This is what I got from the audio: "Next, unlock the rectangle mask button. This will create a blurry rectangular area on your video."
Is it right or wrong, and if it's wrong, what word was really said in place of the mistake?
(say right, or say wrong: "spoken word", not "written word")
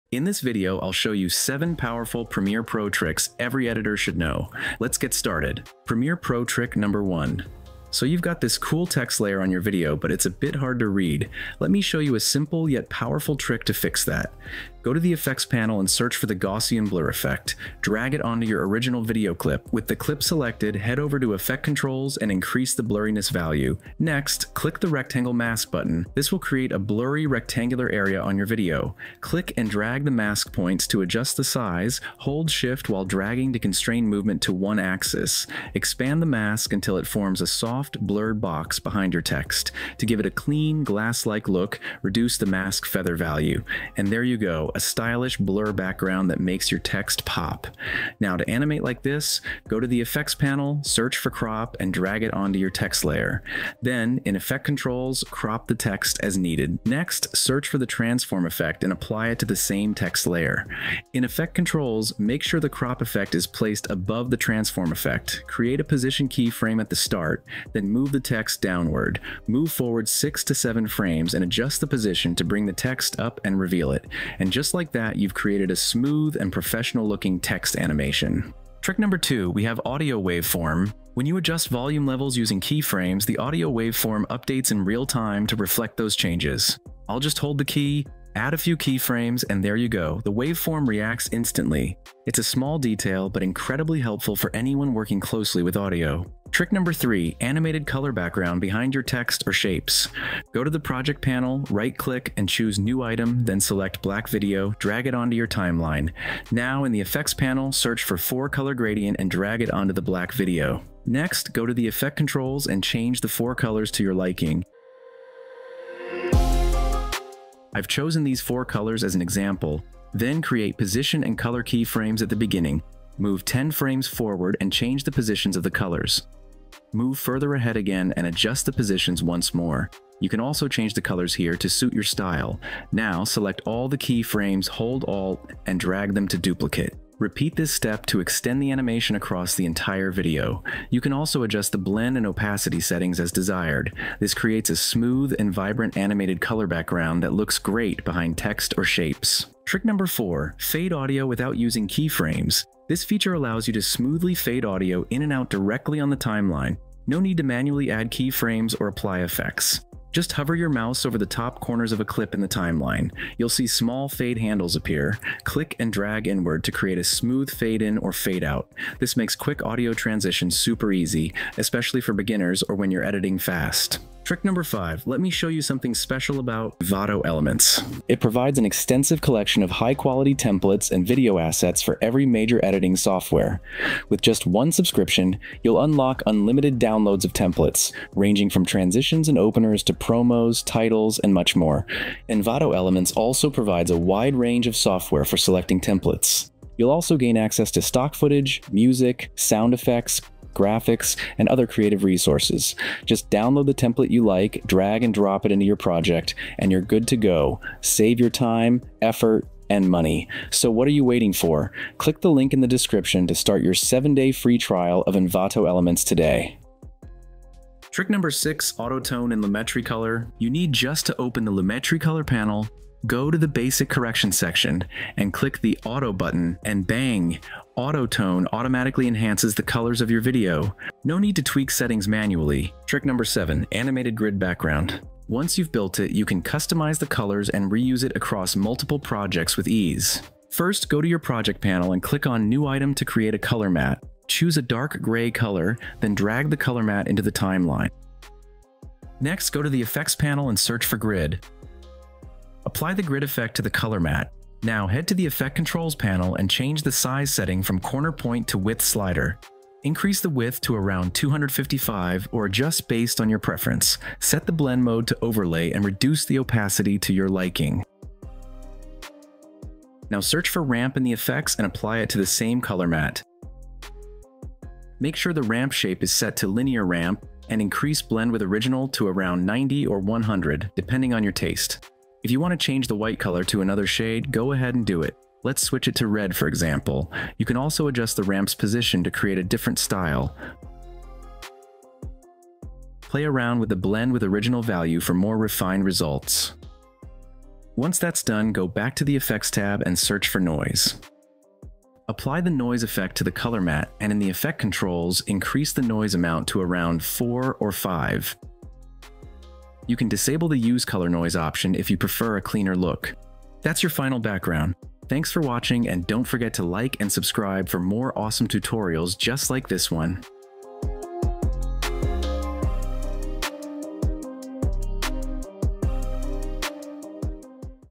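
wrong: "click", not "unlock".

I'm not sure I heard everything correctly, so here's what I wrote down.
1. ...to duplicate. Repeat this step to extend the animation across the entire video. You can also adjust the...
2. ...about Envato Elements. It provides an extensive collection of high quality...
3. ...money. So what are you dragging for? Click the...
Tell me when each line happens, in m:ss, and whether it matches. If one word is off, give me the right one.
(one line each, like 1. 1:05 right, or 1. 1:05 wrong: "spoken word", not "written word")
1. 2:16 right
2. 2:56 right
3. 3:29 wrong: "waiting", not "dragging".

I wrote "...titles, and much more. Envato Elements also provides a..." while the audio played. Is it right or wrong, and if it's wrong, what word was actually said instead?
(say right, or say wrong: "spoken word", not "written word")
right.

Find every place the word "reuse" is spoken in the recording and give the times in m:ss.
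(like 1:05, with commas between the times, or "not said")
3:57.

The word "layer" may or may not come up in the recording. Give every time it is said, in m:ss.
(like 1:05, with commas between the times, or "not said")
0:09, 0:53, 1:00.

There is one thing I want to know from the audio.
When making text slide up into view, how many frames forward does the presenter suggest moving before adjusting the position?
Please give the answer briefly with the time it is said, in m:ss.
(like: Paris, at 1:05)
6 to 7, at 1:10.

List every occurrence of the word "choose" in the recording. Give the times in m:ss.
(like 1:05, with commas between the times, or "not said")
1:42, 4:04.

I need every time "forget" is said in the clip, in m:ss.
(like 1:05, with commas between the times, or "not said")
5:16.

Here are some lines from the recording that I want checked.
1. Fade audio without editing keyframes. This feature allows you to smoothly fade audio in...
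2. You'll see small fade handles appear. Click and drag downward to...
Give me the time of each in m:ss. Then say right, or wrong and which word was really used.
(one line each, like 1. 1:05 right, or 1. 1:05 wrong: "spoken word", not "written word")
1. 2:30 wrong: "using", not "editing"
2. 2:43 wrong: "inward", not "downward".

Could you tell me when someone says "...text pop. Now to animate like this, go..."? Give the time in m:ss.
0:46.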